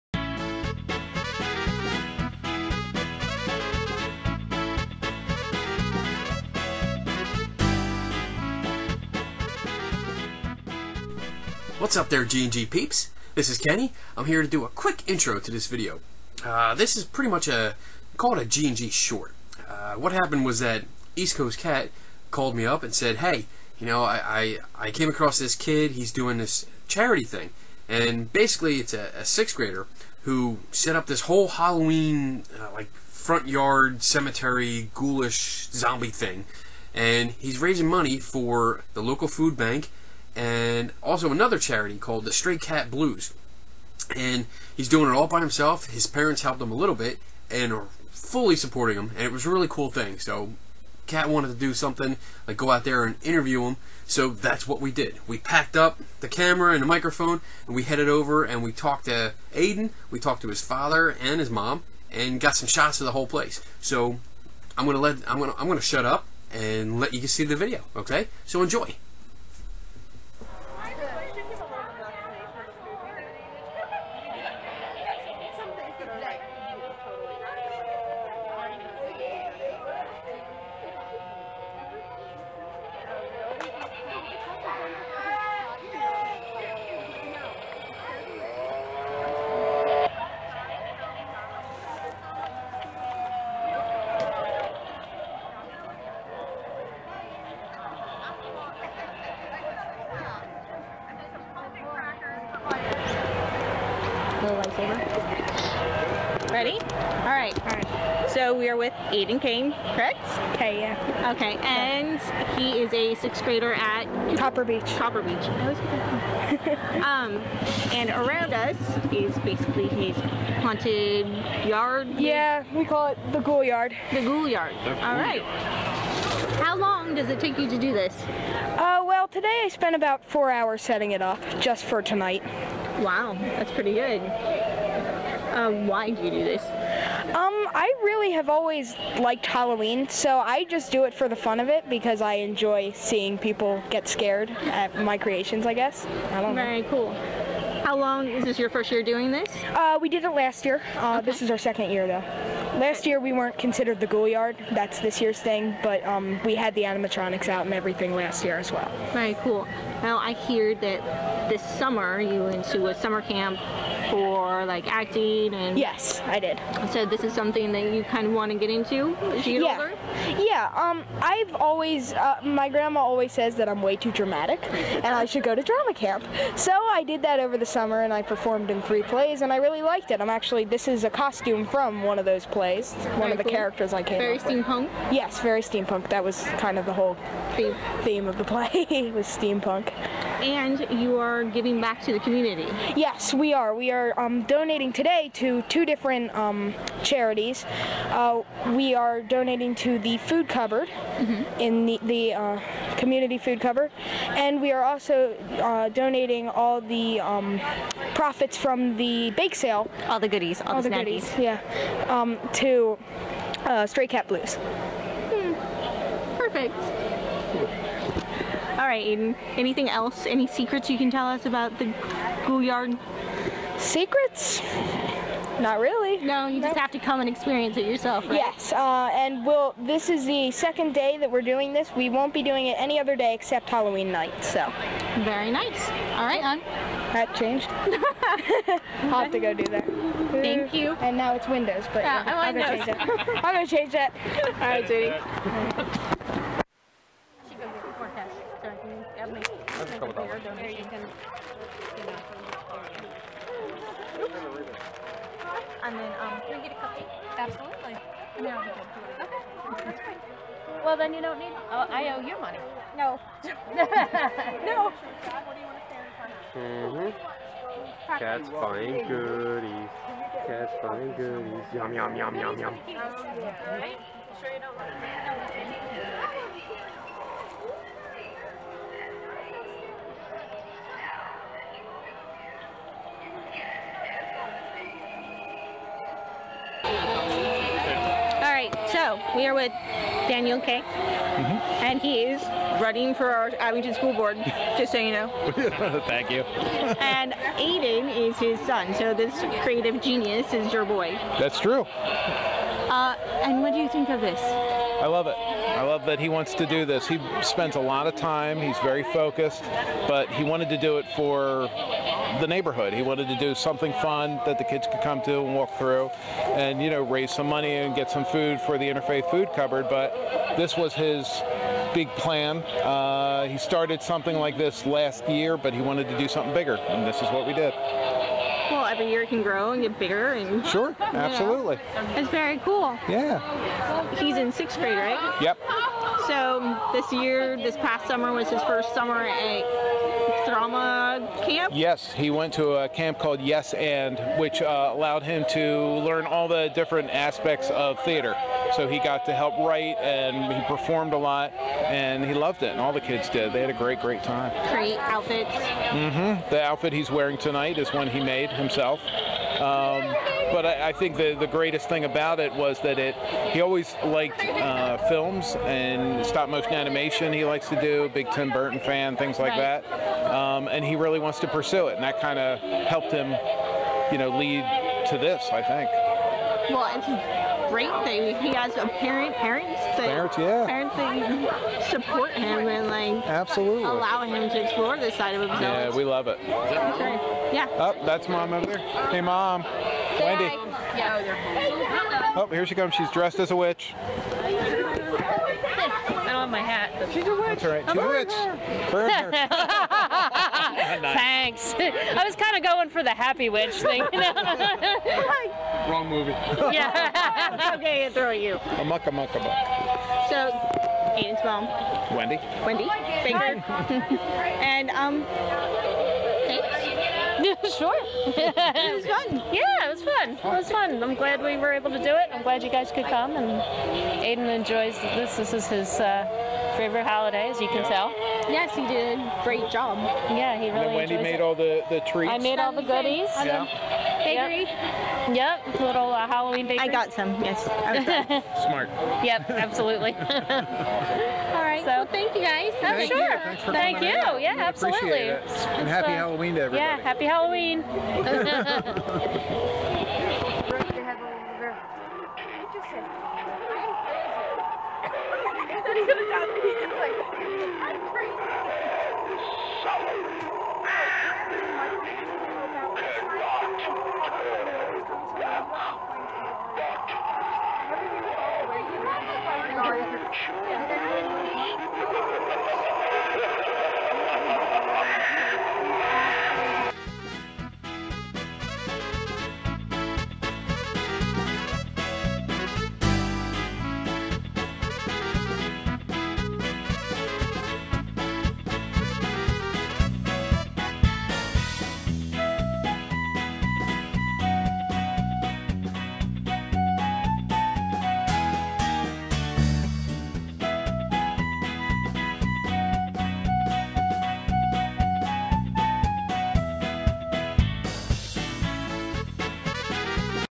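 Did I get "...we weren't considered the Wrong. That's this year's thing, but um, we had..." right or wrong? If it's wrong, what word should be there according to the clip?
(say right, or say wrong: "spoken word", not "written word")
wrong: "Ghoulyard", not "Wrong".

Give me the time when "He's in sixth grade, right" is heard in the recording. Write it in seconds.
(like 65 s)
334 s.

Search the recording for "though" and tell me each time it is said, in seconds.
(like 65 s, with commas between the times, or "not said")
152 s.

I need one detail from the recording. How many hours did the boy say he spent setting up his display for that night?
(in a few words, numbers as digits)
4.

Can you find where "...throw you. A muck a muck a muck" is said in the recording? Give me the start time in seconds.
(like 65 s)
408 s.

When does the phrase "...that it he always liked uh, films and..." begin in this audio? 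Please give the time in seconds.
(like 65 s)
362 s.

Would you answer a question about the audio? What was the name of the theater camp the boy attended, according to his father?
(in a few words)
Yes and.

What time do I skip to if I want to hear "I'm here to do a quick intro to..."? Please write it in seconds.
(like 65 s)
14 s.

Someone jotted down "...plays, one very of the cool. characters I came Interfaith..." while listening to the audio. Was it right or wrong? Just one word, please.
wrong.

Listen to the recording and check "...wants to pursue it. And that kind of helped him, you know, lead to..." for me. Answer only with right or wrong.
right.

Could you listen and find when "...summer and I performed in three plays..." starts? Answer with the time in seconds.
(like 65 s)
177 s.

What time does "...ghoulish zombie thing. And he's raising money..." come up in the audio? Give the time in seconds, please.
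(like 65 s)
34 s.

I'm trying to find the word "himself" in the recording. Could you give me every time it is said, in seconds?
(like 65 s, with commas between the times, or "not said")
45 s, 358 s, 385 s.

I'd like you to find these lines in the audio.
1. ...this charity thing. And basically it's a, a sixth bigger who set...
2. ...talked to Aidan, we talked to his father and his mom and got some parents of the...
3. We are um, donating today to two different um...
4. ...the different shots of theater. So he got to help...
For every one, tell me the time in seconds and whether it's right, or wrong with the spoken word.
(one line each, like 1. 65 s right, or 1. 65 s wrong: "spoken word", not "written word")
1. 26 s wrong: "grader", not "bigger"
2. 58 s wrong: "shots", not "parents"
3. 193 s right
4. 346 s wrong: "aspects", not "shots".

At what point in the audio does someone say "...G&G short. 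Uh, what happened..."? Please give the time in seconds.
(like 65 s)
18 s.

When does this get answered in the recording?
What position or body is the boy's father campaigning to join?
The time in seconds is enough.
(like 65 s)
293 s.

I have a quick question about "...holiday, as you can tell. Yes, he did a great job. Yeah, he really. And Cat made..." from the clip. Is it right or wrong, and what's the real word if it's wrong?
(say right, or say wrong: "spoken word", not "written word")
wrong: "Wendy", not "Cat".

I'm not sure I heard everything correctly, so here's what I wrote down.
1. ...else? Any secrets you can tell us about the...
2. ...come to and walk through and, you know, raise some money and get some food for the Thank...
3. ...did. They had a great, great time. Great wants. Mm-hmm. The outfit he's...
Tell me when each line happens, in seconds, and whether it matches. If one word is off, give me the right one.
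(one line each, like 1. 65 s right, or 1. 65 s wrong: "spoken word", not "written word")
1. 219 s right
2. 315 s wrong: "Interfaith", not "Thank"
3. 353 s wrong: "outfits", not "wants".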